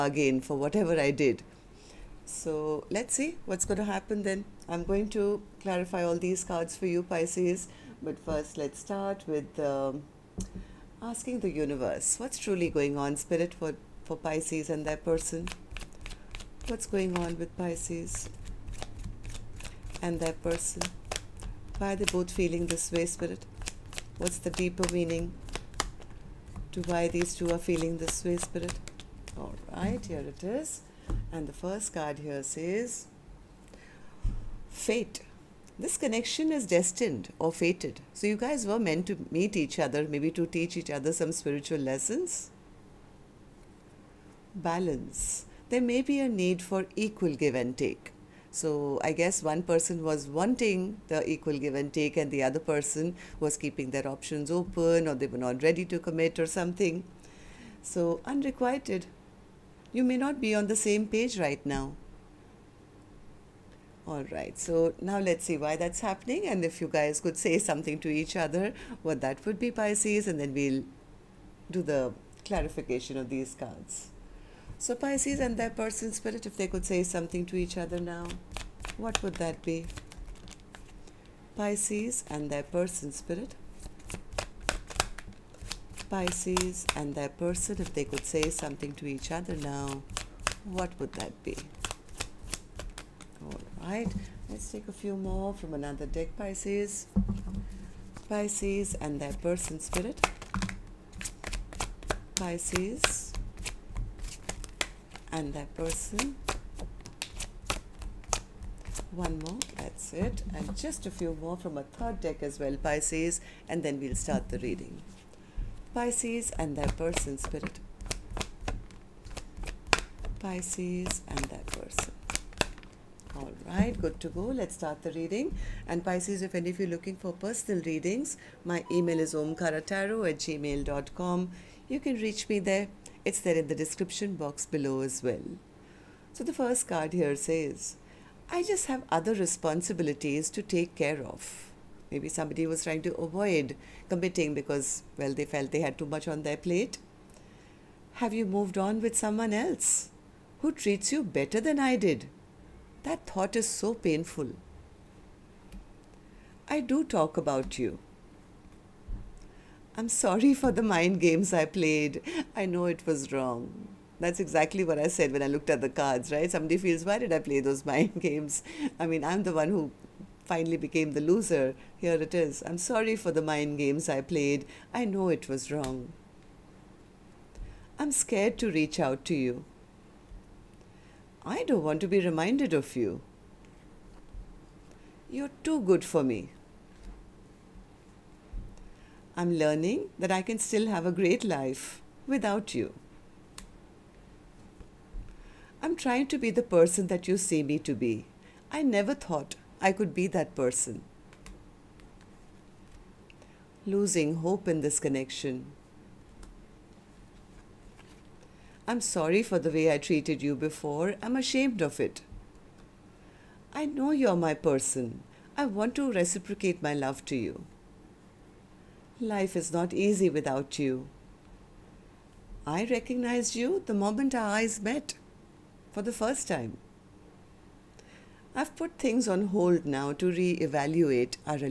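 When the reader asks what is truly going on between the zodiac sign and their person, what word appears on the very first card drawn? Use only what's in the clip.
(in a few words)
Fate.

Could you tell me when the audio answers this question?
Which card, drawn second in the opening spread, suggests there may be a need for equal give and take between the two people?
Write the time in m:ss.
0:44.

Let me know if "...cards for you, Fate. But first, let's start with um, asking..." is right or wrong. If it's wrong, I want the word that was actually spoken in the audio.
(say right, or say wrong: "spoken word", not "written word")
wrong: "Pisces", not "Fate".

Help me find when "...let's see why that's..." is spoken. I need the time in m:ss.
1:05.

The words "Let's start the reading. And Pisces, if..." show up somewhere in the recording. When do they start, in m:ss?
2:04.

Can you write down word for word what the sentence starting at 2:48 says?
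I mean, I'm the one who finally became the loser.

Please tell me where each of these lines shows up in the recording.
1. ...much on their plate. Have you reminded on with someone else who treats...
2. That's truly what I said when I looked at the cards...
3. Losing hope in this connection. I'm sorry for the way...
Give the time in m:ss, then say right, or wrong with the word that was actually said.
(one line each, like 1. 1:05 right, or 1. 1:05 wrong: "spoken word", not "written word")
1. 2:26 wrong: "moved", not "reminded"
2. 2:44 wrong: "exactly", not "truly"
3. 3:23 right.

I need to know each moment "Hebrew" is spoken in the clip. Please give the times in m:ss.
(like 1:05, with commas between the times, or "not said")
not said.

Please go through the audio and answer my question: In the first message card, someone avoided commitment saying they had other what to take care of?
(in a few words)
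Responsibilities.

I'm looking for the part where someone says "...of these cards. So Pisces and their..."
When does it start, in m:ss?
1:13.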